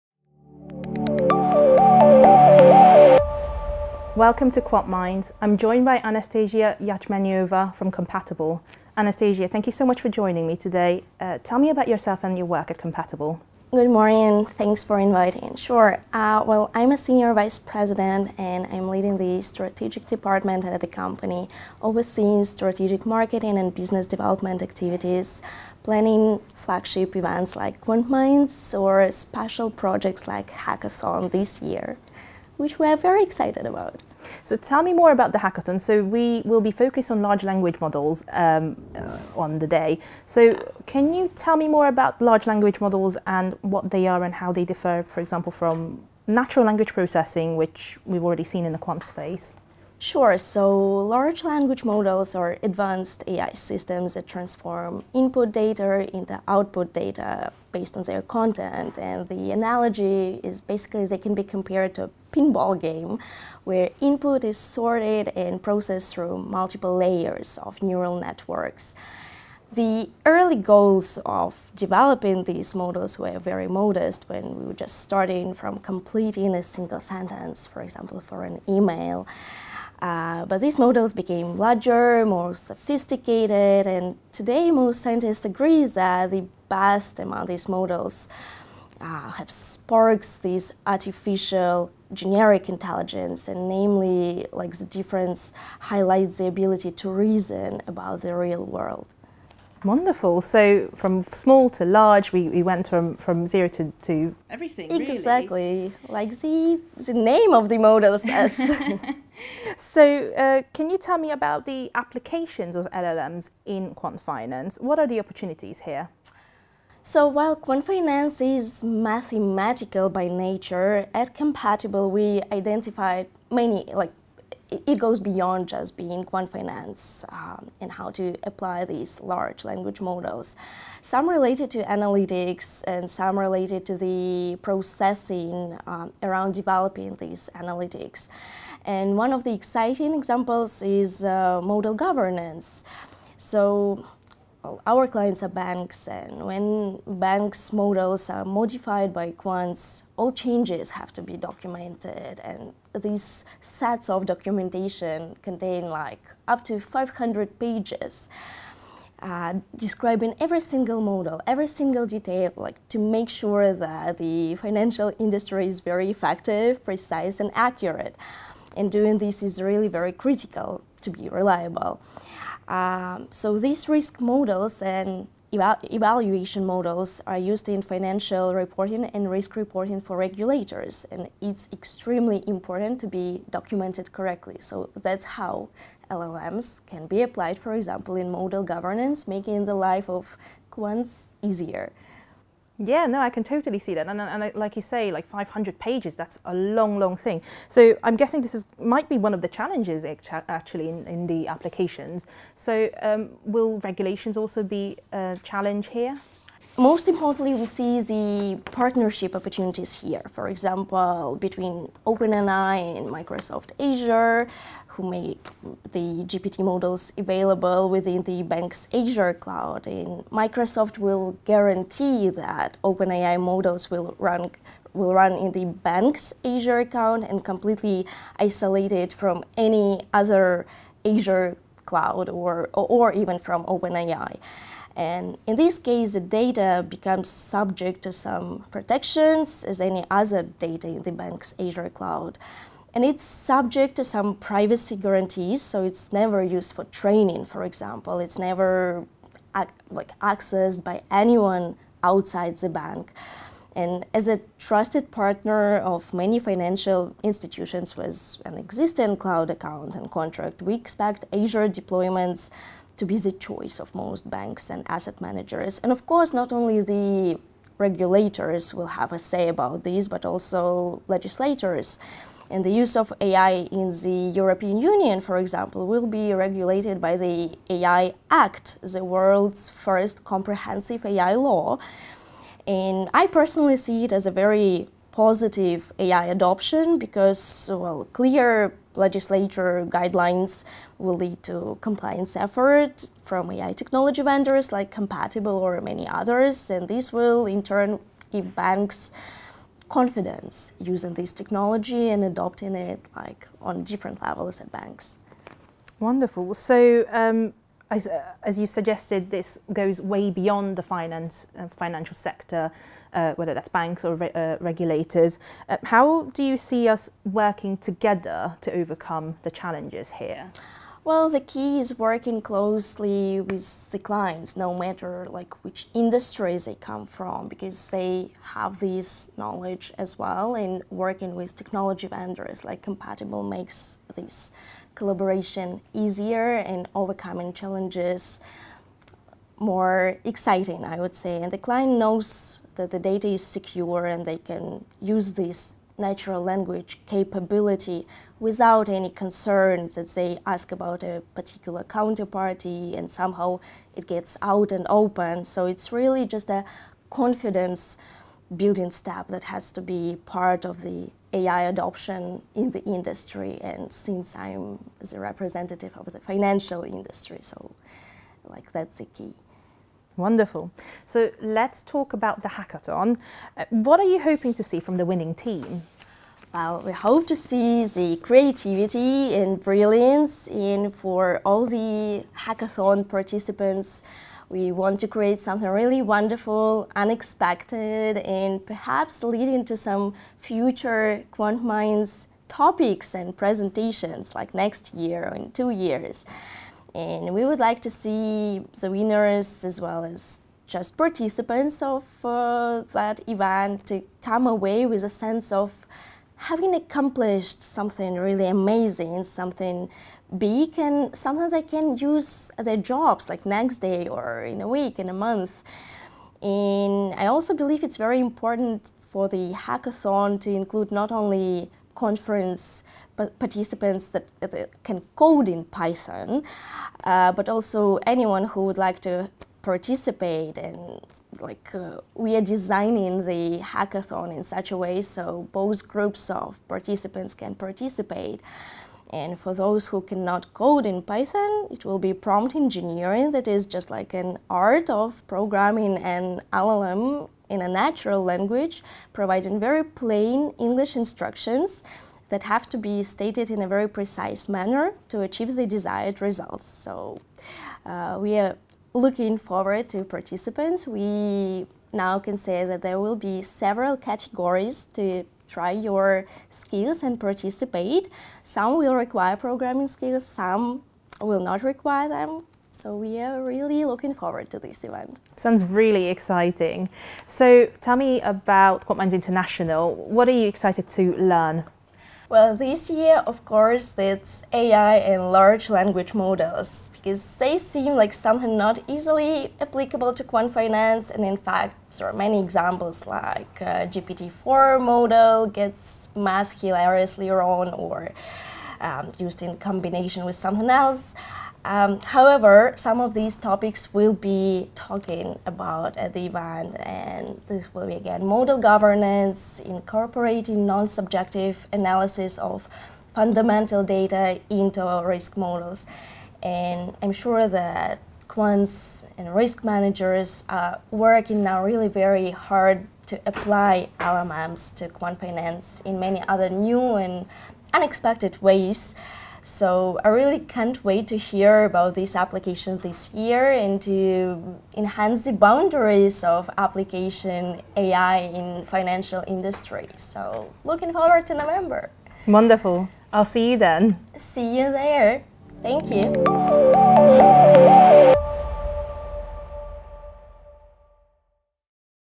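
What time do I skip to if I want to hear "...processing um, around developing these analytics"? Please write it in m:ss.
2:14.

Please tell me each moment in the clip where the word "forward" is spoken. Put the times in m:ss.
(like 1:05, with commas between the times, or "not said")
7:39, 7:54, 9:00.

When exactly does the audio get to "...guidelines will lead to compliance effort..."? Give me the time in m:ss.
4:49.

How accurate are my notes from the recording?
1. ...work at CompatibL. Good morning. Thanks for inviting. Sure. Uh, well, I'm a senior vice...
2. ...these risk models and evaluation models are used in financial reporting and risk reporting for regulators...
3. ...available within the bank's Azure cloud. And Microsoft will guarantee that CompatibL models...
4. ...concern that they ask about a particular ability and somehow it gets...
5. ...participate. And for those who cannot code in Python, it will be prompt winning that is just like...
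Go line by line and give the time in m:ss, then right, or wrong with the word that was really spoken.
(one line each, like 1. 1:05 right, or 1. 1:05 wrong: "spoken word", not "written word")
1. 0:12 right
2. 2:53 right
3. 3:37 wrong: "OpenAI", not "CompatibL"
4. 5:49 wrong: "counterparty", not "ability"
5. 7:17 wrong: "engineering", not "winning".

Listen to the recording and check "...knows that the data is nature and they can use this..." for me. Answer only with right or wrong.
wrong.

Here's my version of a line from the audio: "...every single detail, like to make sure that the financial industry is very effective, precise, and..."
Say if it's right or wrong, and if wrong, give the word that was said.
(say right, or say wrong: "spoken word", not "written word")
right.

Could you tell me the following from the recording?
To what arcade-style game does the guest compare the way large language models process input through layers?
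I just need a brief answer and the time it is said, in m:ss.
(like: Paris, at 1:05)
pinball, at 1:02.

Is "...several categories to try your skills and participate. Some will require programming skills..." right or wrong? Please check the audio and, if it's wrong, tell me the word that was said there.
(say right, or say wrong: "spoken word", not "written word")
right.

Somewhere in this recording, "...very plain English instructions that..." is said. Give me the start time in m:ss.
7:29.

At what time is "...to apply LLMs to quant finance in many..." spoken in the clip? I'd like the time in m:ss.
8:43.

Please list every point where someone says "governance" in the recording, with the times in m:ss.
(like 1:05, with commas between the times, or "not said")
2:21, 3:08, 8:28.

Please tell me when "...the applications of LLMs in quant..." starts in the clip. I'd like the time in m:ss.
1:51.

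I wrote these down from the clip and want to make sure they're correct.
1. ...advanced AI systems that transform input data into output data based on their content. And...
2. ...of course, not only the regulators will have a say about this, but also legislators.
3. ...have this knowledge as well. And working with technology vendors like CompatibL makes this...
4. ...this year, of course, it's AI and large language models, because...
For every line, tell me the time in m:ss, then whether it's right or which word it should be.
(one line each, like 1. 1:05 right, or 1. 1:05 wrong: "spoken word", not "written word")
1. 0:52 right
2. 4:25 right
3. 5:28 right
4. 8:02 right.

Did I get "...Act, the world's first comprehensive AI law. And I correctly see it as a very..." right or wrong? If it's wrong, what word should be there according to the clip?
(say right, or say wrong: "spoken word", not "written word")
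wrong: "personally", not "correctly".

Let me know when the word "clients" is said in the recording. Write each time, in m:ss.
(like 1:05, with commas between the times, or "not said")
2:25, 5:23, 5:41.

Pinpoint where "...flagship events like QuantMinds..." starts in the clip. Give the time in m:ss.
0:26.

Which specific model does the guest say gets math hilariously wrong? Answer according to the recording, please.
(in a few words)
GPT-4.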